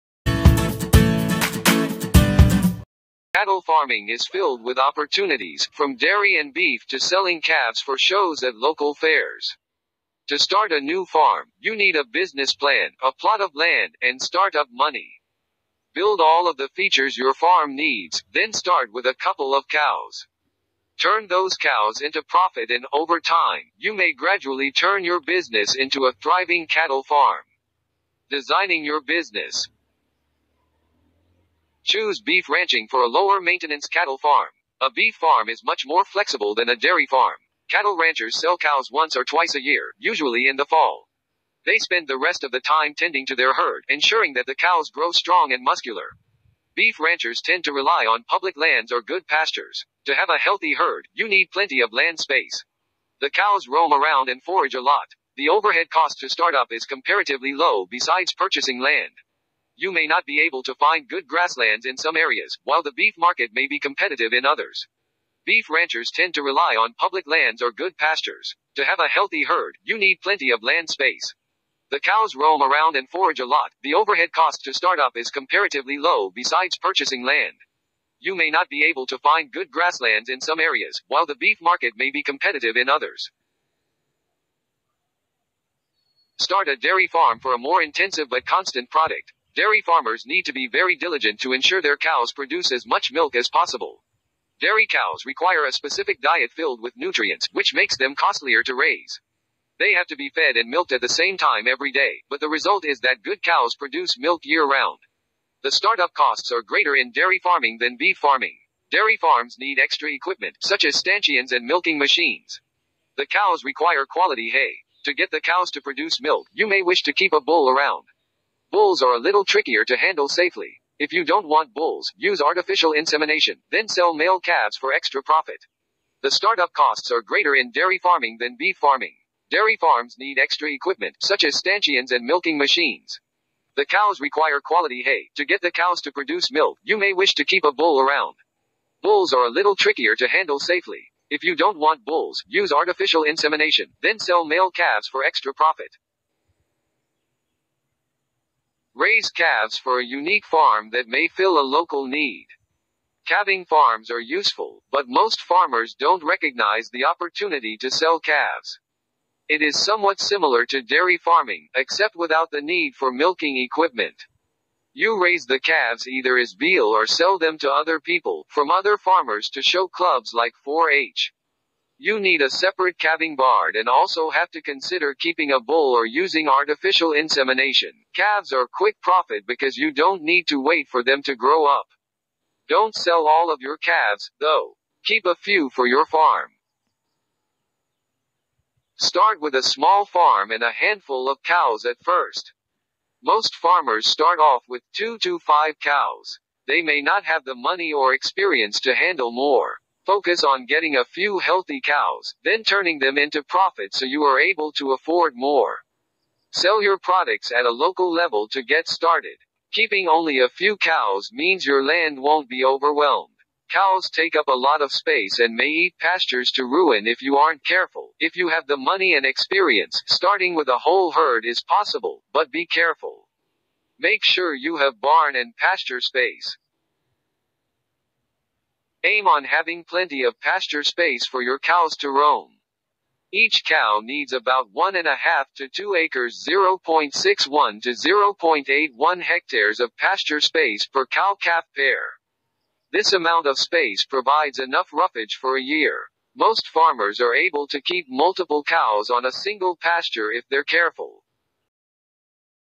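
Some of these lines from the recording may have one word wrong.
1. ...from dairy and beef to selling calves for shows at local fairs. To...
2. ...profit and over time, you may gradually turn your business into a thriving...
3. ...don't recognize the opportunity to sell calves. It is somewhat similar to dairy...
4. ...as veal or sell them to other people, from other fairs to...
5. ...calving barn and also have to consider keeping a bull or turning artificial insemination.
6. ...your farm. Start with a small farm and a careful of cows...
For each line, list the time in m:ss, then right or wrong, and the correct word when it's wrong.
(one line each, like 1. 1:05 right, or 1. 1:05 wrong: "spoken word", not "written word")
1. 0:05 right
2. 0:22 right
3. 2:35 right
4. 2:46 wrong: "farmers", not "fairs"
5. 2:52 wrong: "using", not "turning"
6. 3:05 wrong: "handful", not "careful".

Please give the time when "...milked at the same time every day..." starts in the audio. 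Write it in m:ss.
1:40.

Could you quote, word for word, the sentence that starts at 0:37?
Cattle ranchers sell cows once or twice a year, usually in the fall.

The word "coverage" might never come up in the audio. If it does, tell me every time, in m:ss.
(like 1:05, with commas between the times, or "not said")
not said.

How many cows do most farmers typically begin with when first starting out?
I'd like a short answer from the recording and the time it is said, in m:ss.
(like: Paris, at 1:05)
2 to 5, at 3:14.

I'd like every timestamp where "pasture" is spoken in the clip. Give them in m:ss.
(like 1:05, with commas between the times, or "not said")
0:49, 1:07, 3:35, 3:45, 3:50, 3:59, 4:09.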